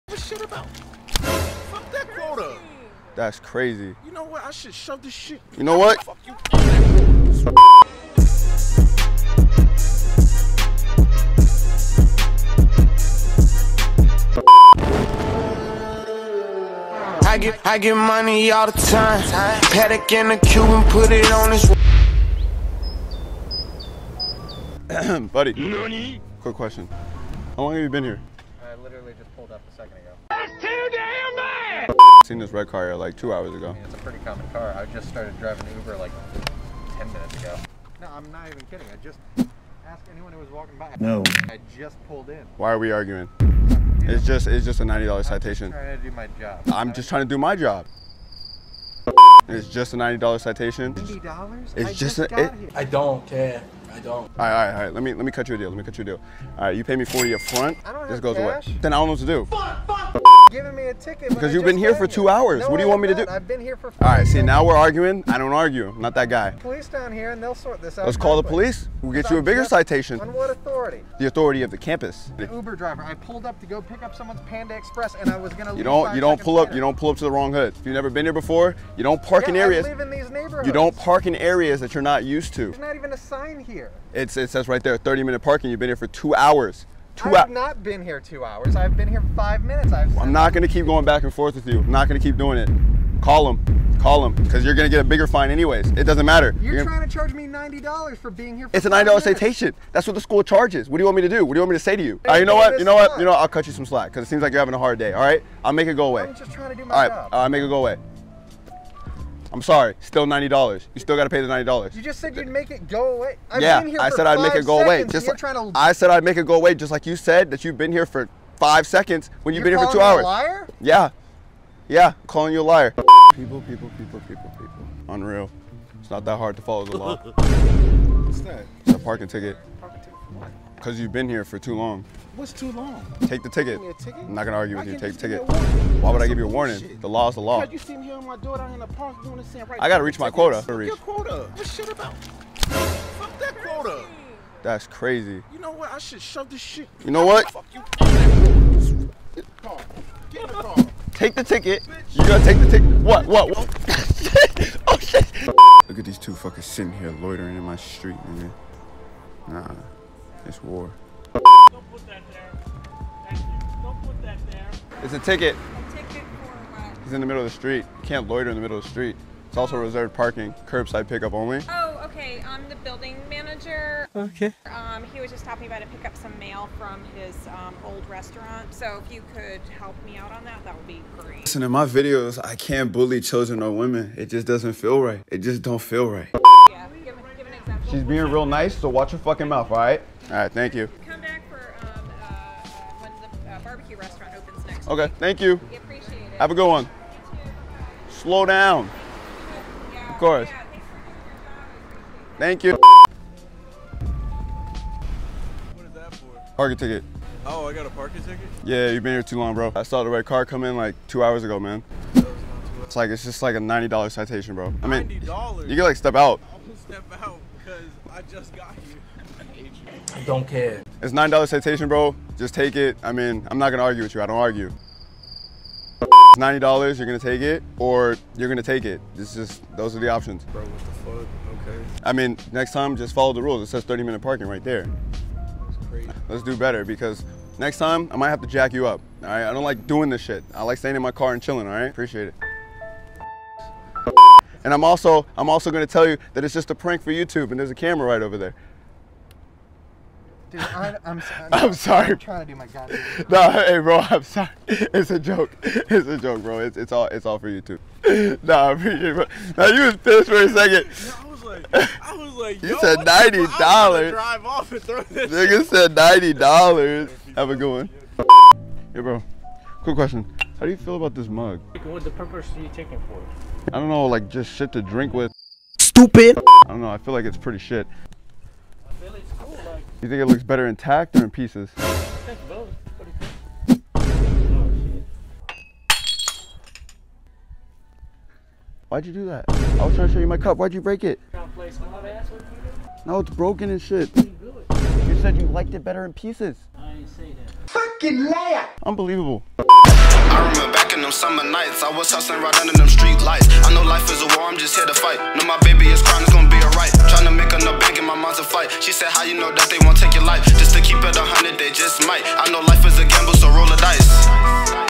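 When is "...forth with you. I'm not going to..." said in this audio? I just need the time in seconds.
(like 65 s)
91 s.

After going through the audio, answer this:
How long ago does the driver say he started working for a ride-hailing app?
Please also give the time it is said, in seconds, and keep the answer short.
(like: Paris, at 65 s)
10 minutes ago, at 36 s.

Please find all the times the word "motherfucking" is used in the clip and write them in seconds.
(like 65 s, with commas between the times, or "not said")
not said.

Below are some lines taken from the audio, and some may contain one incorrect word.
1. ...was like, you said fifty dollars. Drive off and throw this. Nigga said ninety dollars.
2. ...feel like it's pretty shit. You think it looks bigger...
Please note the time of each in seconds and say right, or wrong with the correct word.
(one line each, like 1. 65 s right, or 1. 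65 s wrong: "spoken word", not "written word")
1. 262 s wrong: "ninety", not "fifty"
2. 276 s wrong: "better", not "bigger".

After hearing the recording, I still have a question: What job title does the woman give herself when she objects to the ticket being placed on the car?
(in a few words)
Building manager.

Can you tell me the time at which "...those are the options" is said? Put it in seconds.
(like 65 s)
229 s.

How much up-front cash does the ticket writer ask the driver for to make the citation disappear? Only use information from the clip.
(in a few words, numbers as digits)
40.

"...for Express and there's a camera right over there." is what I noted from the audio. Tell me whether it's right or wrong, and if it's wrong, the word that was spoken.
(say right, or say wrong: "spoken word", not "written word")
wrong: "YouTube", not "Express".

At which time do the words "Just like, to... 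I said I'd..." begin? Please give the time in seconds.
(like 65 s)
115 s.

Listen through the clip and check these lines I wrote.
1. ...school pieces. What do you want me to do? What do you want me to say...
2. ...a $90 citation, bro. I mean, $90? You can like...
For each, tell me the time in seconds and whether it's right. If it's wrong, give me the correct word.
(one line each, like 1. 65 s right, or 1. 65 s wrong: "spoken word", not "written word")
1. 100 s wrong: "charges", not "pieces"
2. 213 s right.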